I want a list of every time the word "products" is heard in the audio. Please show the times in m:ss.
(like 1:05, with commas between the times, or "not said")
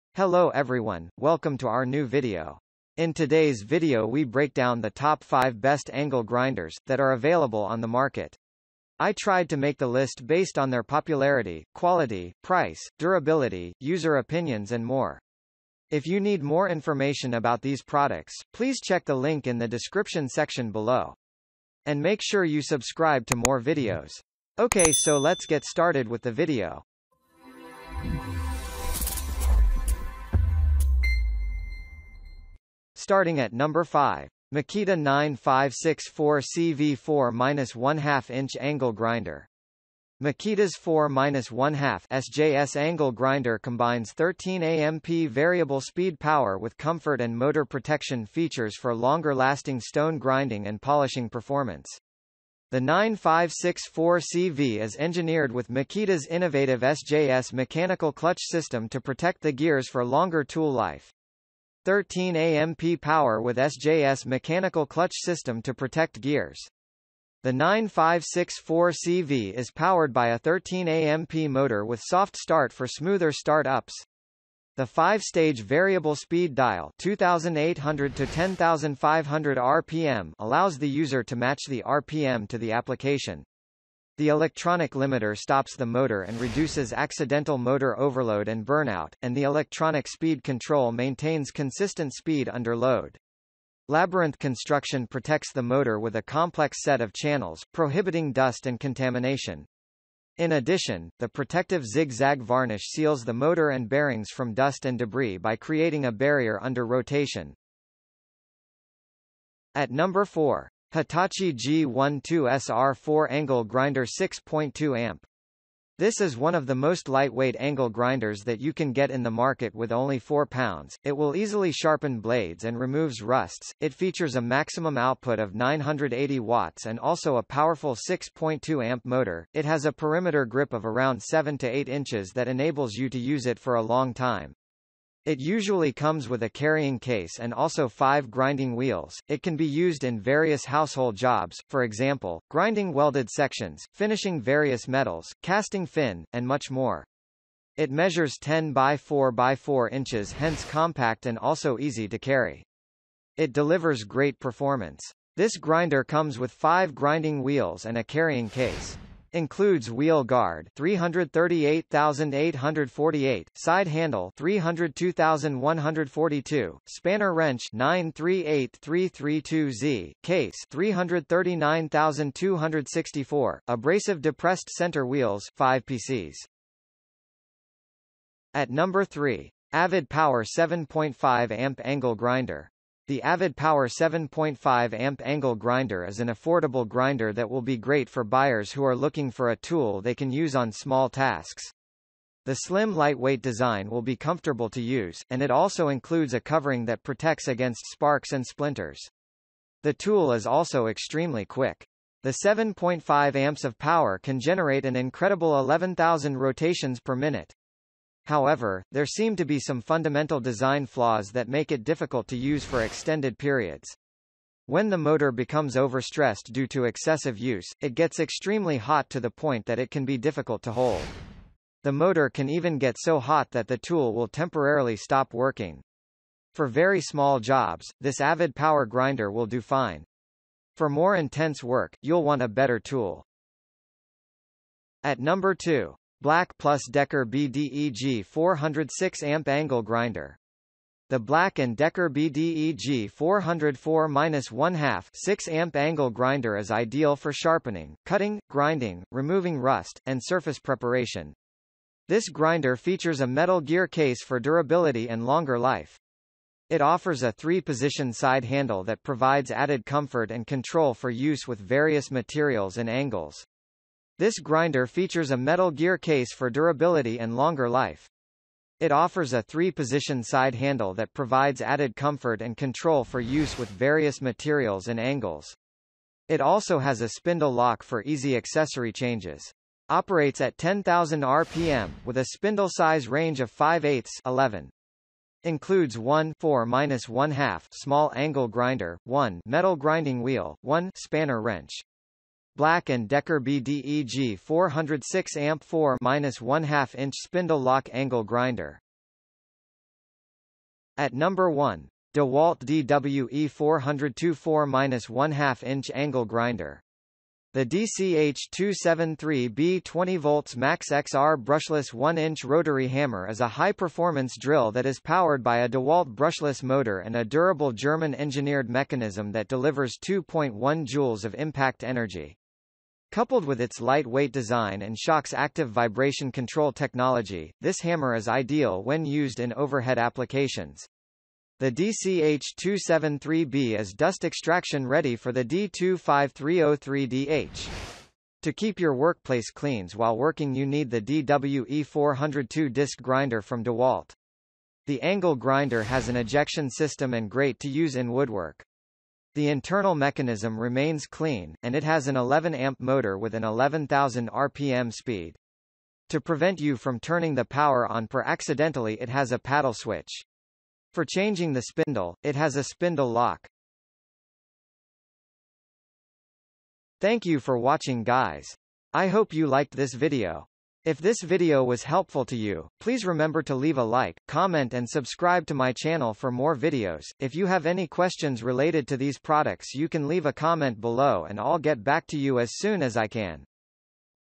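0:17, 6:19.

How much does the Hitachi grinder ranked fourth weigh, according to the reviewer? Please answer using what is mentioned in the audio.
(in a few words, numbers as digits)
4 pounds.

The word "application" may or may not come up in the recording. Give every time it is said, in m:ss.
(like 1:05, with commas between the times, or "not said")
1:22, 5:29.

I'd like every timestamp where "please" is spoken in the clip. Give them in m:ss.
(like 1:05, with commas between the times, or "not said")
0:18, 6:12.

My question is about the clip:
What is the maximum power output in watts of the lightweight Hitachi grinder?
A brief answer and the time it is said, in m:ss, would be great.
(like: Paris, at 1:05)
980 watts, at 2:05.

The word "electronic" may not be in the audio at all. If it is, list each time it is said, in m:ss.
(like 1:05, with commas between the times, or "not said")
1:24, 1:29.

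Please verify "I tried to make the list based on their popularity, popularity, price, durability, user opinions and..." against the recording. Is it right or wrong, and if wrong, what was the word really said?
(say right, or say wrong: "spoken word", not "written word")
wrong: "quality", not "popularity".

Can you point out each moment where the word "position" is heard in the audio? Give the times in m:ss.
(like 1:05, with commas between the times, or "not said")
4:17, 4:29.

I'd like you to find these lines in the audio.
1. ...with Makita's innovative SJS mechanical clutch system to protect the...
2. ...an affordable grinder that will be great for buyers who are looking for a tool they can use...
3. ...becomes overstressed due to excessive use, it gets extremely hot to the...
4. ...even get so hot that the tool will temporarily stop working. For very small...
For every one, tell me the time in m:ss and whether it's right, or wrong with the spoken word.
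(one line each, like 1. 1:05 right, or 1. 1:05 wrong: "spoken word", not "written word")
1. 0:55 right
2. 3:06 right
3. 3:35 right
4. 3:42 right.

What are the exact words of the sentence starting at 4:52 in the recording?
Black & Decker BDEG 406 amp 4 1/2 inch spindle lock angle grinder.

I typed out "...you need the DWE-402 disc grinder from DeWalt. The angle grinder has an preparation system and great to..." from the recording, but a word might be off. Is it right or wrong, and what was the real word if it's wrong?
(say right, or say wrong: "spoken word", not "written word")
wrong: "ejection", not "preparation".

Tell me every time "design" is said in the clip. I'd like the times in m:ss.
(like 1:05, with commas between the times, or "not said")
3:13, 3:30, 5:24.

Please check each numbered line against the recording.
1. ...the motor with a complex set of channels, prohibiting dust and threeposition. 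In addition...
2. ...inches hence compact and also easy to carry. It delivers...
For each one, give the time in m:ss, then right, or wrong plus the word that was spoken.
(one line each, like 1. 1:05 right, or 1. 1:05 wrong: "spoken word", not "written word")
1. 1:35 wrong: "contamination", not "threeposition"
2. 2:29 right.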